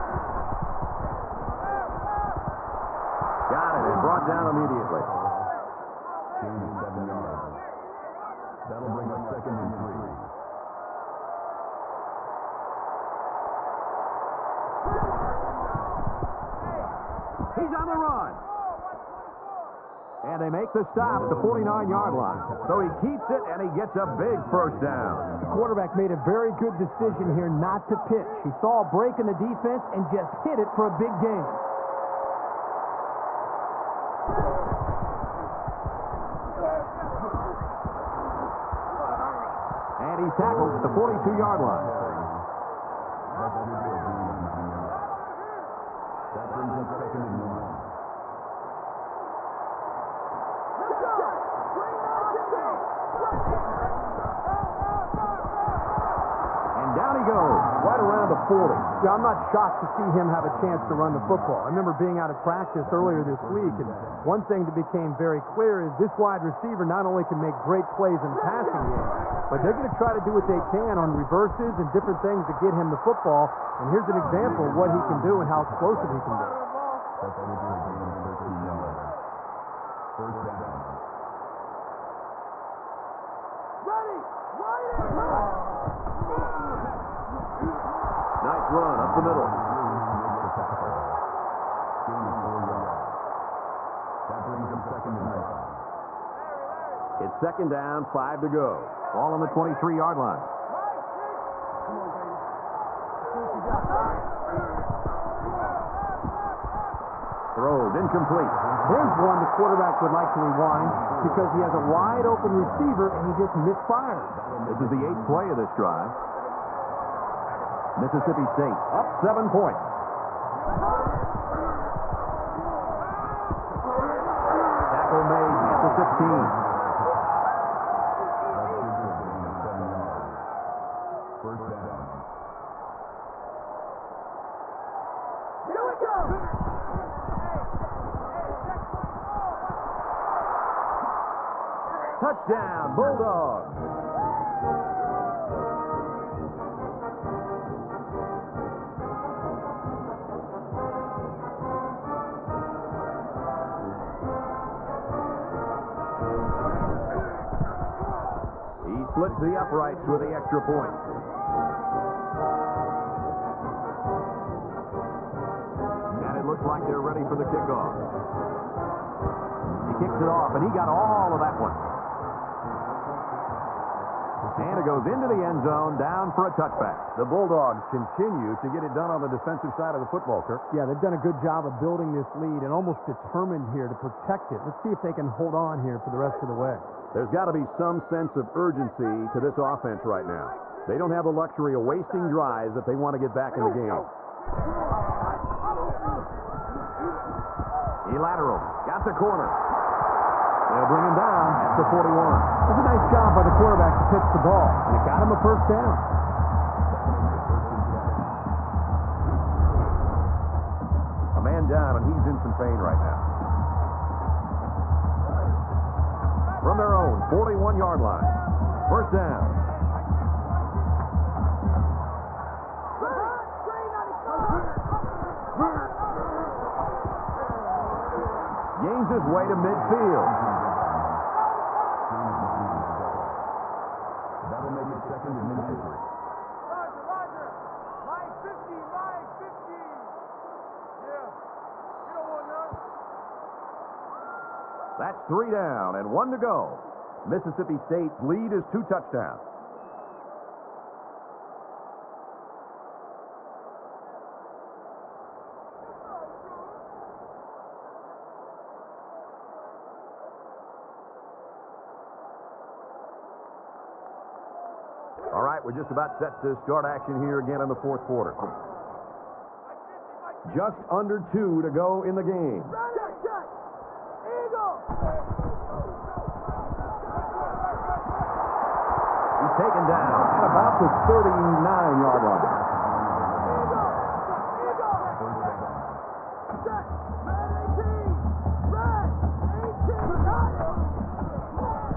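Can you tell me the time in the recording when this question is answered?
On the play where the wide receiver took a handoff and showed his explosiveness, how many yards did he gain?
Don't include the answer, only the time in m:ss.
1:18.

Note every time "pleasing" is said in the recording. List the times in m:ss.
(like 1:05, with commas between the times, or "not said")
not said.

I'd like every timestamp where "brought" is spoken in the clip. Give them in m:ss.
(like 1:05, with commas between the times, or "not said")
0:04.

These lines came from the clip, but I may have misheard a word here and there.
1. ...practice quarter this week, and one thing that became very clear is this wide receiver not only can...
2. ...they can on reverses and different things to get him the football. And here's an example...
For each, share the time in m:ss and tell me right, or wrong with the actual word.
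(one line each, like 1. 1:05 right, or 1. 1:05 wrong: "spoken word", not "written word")
1. 1:02 wrong: "earlier", not "quarter"
2. 1:10 right.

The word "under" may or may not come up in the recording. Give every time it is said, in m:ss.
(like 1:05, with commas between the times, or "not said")
4:30.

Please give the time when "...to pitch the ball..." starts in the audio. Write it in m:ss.
3:23.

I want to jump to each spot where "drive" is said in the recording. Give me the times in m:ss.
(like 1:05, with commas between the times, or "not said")
1:55, 3:12.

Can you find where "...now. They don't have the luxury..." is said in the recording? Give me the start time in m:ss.
3:10.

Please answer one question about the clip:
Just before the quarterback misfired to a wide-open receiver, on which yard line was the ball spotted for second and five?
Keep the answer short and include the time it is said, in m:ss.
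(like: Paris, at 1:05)
23, at 1:39.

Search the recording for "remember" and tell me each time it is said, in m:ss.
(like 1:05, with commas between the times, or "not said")
1:01.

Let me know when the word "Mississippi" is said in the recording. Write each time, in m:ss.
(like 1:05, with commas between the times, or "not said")
1:57, 4:07.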